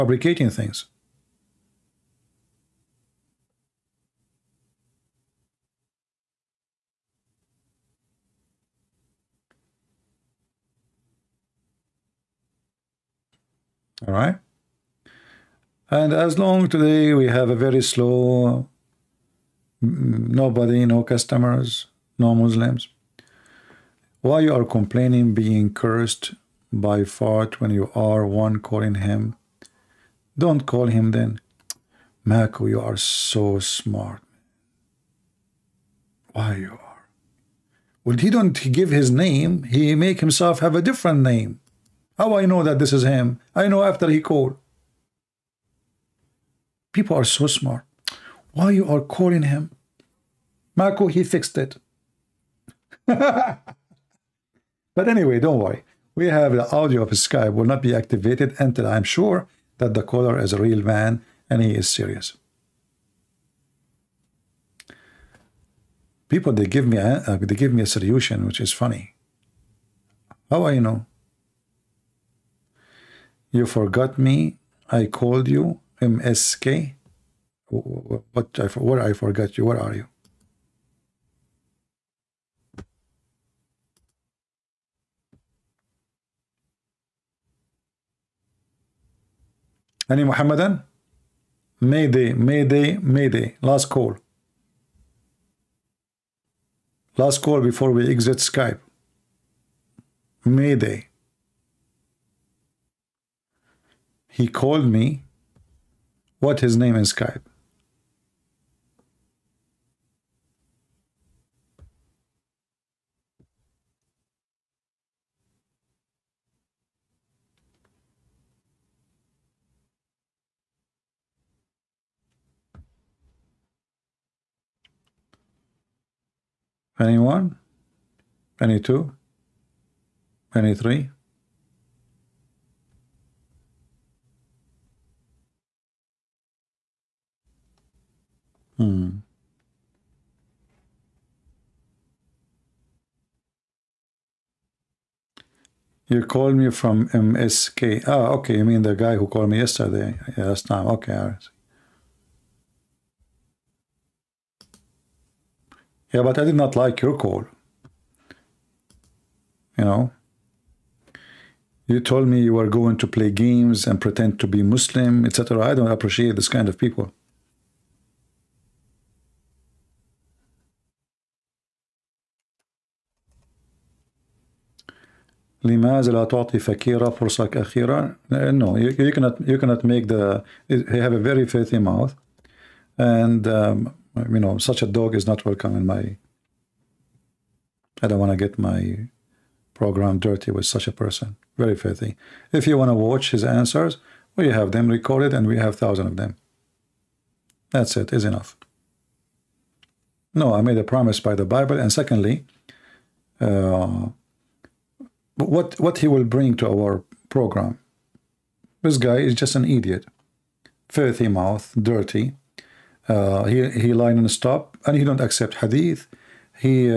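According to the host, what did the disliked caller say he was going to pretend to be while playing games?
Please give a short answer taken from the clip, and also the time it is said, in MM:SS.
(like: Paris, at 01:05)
Muslim, at 02:44.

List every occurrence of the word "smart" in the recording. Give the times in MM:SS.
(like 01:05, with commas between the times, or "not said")
00:33, 00:47.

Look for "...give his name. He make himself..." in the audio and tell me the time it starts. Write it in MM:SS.
00:38.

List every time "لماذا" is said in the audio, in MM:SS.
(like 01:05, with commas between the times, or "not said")
02:55.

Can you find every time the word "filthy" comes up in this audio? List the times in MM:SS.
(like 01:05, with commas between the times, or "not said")
03:01, 03:11, 03:30.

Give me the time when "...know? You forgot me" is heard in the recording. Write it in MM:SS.
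01:10.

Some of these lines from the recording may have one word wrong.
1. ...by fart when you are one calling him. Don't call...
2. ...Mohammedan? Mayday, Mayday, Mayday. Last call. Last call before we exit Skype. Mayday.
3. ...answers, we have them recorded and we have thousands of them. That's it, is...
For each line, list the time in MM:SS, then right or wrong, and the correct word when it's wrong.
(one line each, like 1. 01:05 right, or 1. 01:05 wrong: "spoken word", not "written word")
1. 00:26 right
2. 01:30 right
3. 03:13 right.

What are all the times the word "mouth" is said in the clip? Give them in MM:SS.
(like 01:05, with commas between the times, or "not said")
03:01, 03:31.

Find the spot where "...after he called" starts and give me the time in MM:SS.
00:43.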